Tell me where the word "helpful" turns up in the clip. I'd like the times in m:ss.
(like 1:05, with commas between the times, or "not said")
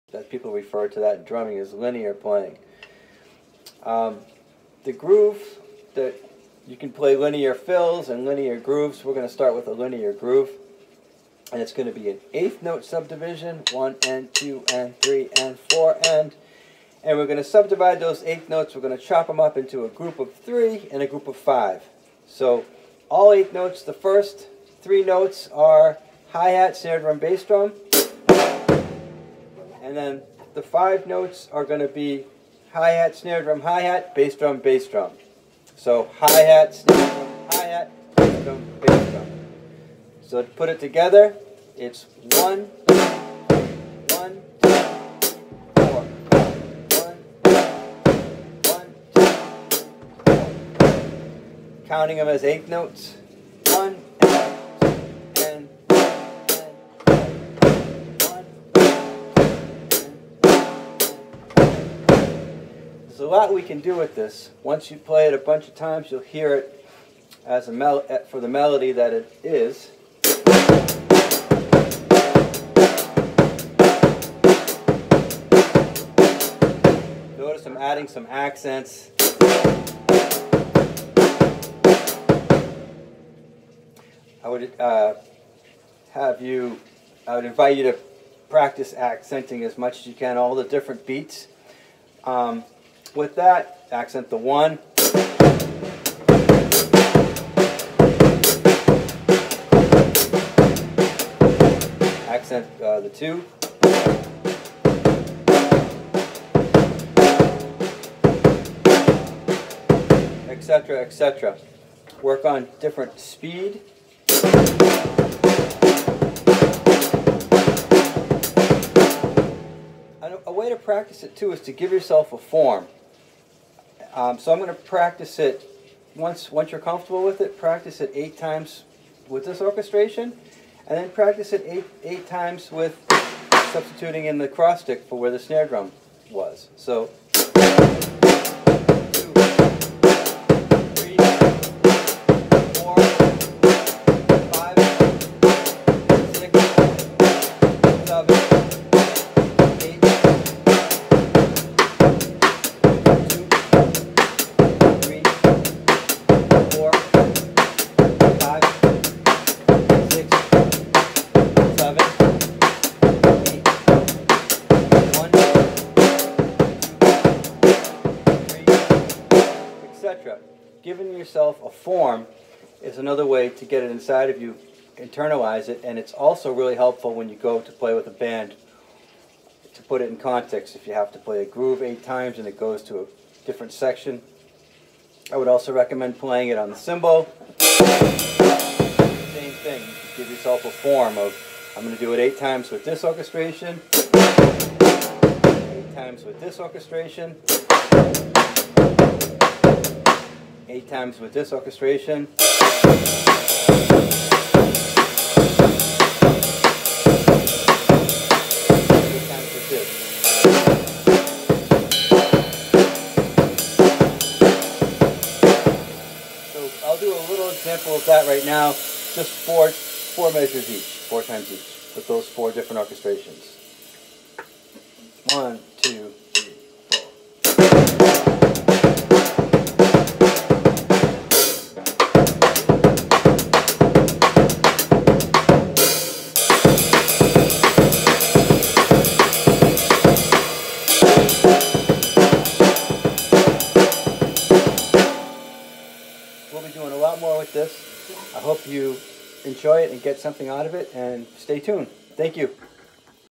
2:56.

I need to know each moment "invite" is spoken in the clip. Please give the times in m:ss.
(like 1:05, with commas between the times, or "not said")
1:27.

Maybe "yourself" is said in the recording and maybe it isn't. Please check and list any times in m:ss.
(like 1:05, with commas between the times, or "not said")
2:01, 2:51, 3:10.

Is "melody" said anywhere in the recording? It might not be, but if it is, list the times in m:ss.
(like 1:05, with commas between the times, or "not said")
1:08.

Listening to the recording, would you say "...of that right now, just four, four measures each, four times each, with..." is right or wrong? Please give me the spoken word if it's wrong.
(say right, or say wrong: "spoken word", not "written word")
right.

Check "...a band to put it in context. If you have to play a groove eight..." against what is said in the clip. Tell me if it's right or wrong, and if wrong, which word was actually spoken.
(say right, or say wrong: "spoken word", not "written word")
right.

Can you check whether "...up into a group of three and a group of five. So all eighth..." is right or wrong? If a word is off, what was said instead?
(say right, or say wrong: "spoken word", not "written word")
right.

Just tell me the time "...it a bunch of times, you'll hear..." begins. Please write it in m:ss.
1:05.